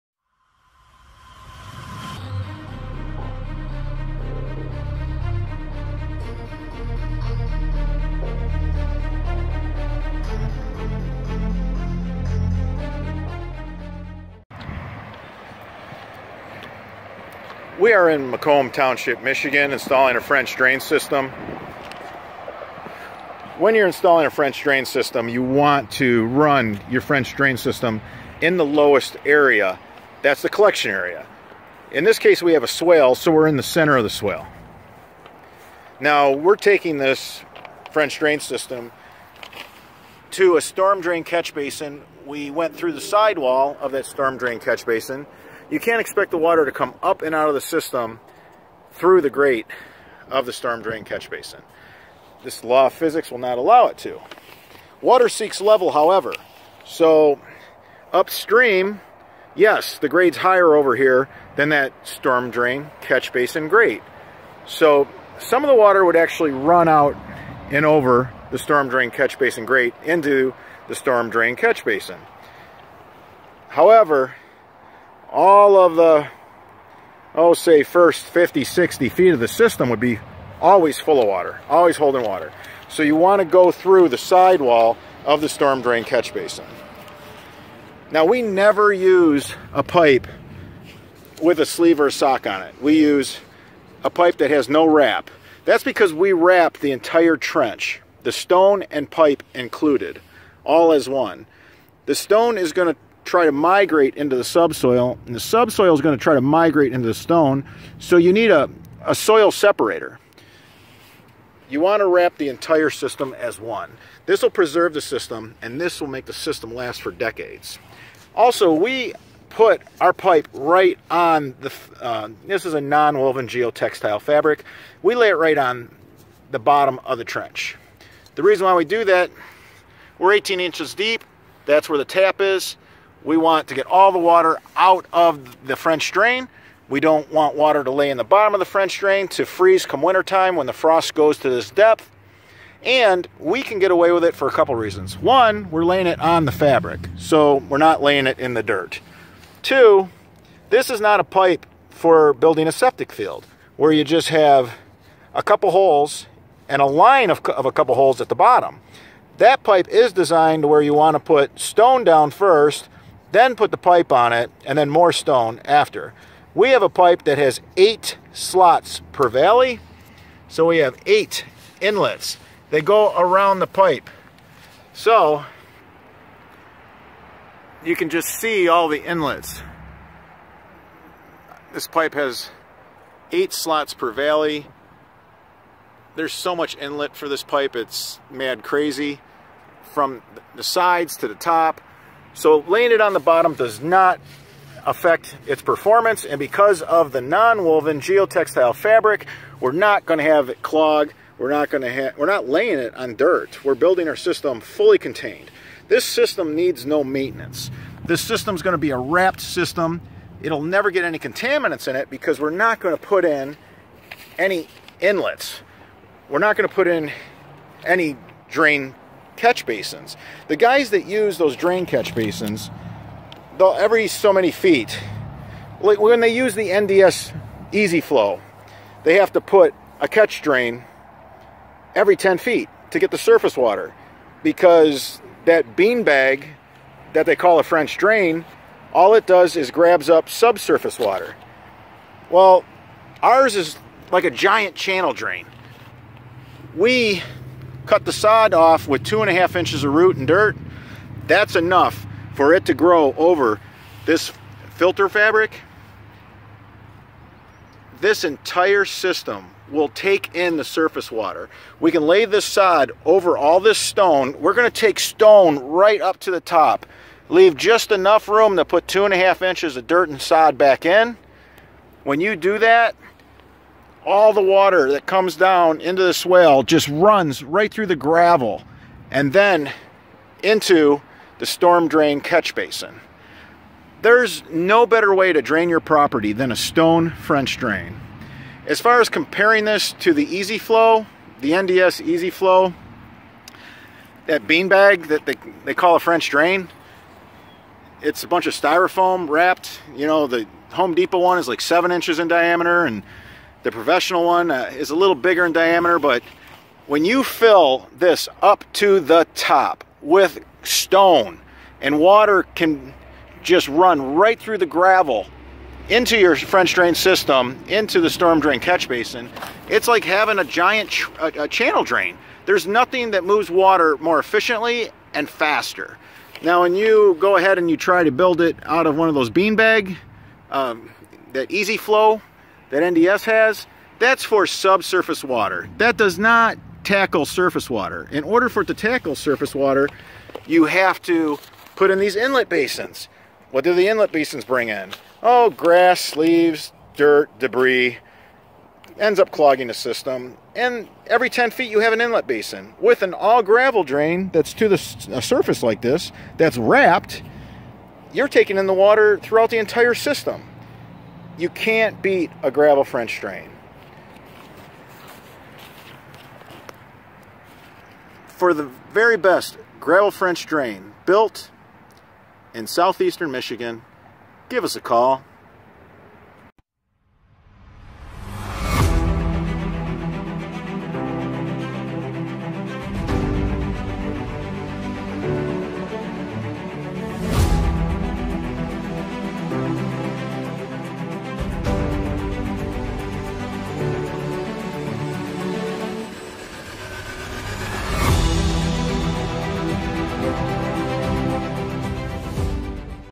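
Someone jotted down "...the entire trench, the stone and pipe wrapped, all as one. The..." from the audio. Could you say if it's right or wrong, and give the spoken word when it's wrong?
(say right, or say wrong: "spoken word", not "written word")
wrong: "included", not "wrapped".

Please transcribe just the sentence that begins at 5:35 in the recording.
That does not tackle surface water.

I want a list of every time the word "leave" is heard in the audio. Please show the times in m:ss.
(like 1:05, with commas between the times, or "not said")
4:27, 5:46.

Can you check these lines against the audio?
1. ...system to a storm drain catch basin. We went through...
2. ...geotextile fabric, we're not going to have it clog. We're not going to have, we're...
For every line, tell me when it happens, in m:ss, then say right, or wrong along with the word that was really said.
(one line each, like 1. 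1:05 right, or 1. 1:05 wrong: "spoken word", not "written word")
1. 0:38 right
2. 3:17 right.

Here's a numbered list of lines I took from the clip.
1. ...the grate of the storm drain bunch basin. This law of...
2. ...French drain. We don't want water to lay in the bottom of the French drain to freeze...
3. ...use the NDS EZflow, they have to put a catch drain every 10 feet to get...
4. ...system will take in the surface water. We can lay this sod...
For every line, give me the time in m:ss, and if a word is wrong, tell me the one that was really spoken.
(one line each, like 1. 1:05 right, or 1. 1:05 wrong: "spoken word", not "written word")
1. 0:49 wrong: "catch", not "bunch"
2. 2:15 right
3. 3:46 right
4. 4:18 right.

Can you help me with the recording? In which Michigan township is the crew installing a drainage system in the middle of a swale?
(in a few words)
Macomb Township.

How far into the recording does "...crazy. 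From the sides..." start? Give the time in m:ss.
3:08.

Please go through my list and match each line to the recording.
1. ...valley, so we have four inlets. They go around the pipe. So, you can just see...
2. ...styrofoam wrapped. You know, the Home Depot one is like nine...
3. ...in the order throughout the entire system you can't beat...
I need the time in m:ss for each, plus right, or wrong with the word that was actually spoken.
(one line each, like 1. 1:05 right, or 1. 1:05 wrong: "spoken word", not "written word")
1. 2:49 wrong: "eight", not "four"
2. 4:58 wrong: "seven", not "nine"
3. 5:58 wrong: "water", not "order".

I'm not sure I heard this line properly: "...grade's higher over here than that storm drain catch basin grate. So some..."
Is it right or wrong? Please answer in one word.
right.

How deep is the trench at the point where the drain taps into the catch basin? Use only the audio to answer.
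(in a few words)
18 inches.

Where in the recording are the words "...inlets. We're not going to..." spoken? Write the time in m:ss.
3:34.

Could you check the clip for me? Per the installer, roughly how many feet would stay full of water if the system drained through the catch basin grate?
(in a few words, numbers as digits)
50, 60 feet.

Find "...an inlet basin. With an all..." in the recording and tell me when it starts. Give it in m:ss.
5:51.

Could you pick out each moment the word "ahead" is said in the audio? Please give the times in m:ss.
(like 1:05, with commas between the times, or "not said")
5:27.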